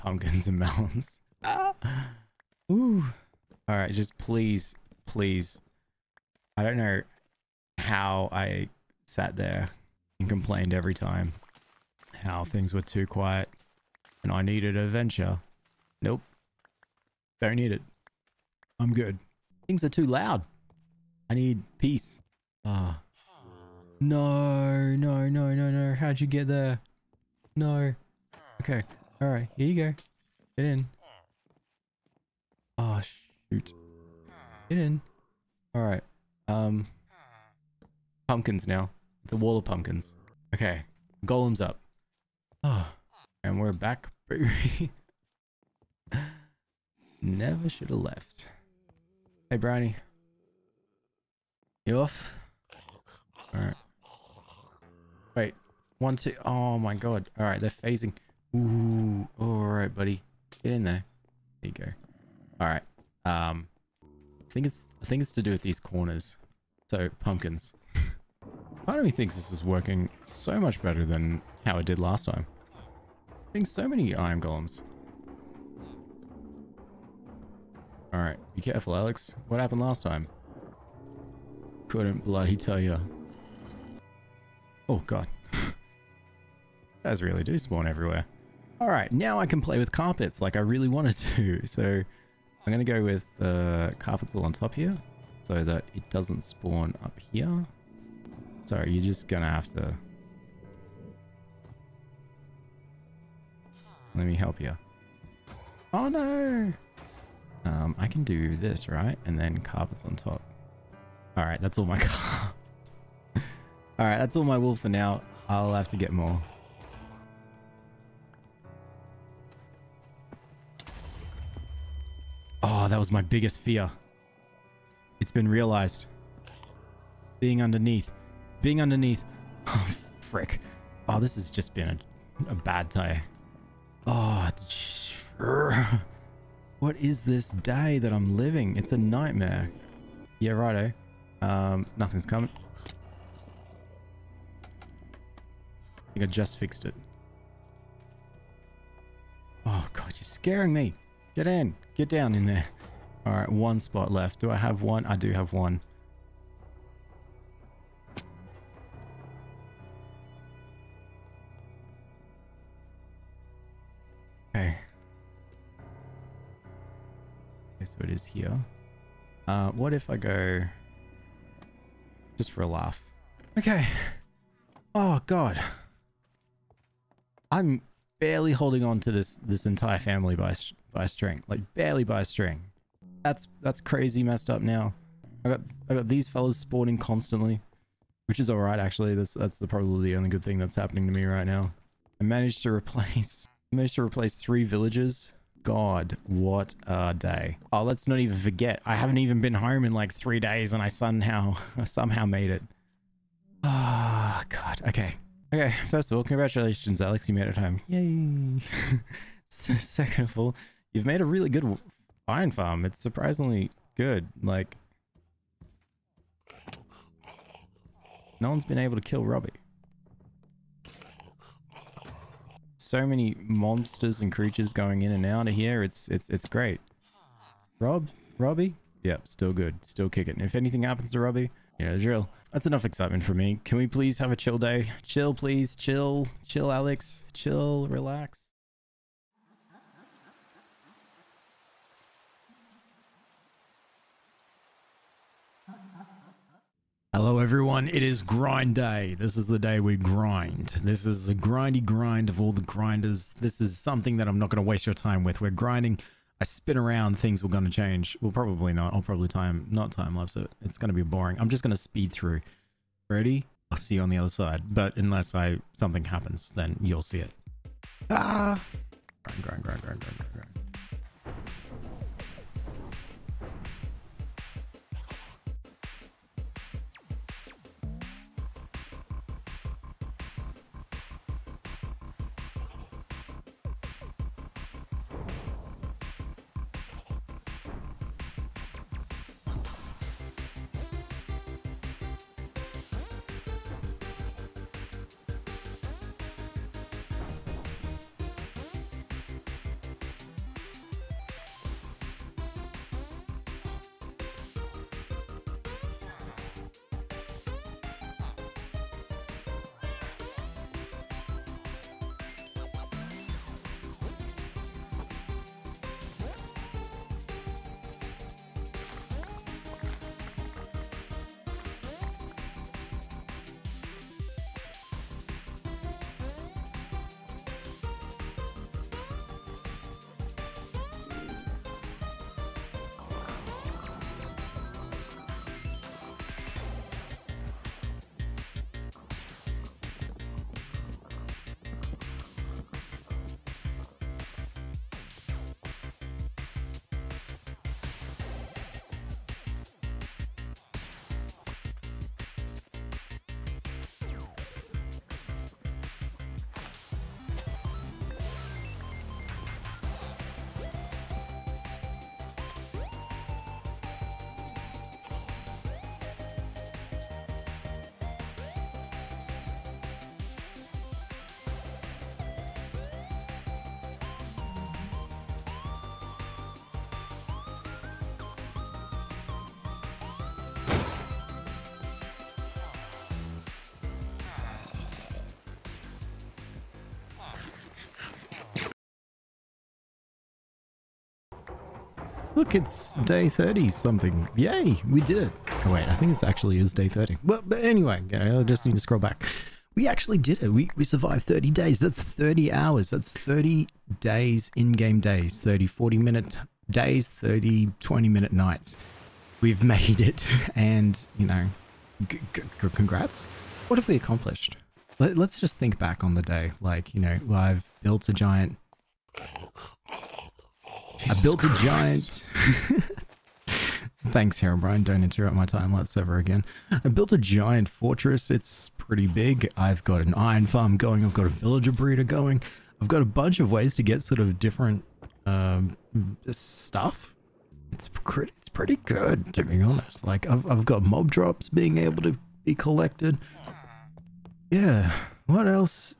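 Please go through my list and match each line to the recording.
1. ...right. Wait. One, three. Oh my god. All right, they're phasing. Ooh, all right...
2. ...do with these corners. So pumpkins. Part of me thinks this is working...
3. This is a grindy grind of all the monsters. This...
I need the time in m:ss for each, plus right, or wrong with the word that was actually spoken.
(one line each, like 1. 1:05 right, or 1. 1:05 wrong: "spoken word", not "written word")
1. 0:53 wrong: "two", not "three"
2. 1:05 right
3. 4:10 wrong: "grinders", not "monsters".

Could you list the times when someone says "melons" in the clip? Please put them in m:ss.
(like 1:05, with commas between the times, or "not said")
0:00.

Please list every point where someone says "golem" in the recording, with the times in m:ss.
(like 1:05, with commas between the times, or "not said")
0:41, 1:14.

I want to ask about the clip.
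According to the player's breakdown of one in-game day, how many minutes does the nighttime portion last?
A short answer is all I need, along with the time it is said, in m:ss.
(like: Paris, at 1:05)
20, at 6:47.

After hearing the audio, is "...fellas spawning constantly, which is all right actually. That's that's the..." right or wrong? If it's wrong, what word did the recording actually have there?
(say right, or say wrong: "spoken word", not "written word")
right.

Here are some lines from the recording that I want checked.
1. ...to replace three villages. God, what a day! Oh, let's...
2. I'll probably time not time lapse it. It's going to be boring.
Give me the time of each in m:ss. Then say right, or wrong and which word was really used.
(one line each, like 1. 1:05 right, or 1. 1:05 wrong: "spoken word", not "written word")
1. 3:13 right
2. 4:18 right.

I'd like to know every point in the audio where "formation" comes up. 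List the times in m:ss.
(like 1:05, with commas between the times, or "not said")
not said.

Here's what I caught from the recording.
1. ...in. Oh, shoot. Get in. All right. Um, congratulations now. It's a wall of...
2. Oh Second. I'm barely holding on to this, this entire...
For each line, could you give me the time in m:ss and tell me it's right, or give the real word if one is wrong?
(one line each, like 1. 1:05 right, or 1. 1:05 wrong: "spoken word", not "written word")
1. 0:30 wrong: "pumpkins", not "congratulations"
2. 2:54 wrong: "God", not "Second".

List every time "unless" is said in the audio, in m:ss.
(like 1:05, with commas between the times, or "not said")
4:24.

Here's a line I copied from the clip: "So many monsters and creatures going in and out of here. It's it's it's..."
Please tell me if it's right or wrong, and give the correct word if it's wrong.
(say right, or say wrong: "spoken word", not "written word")
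right.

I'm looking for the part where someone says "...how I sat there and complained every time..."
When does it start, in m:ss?
0:07.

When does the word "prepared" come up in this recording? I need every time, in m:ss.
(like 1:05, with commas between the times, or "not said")
not said.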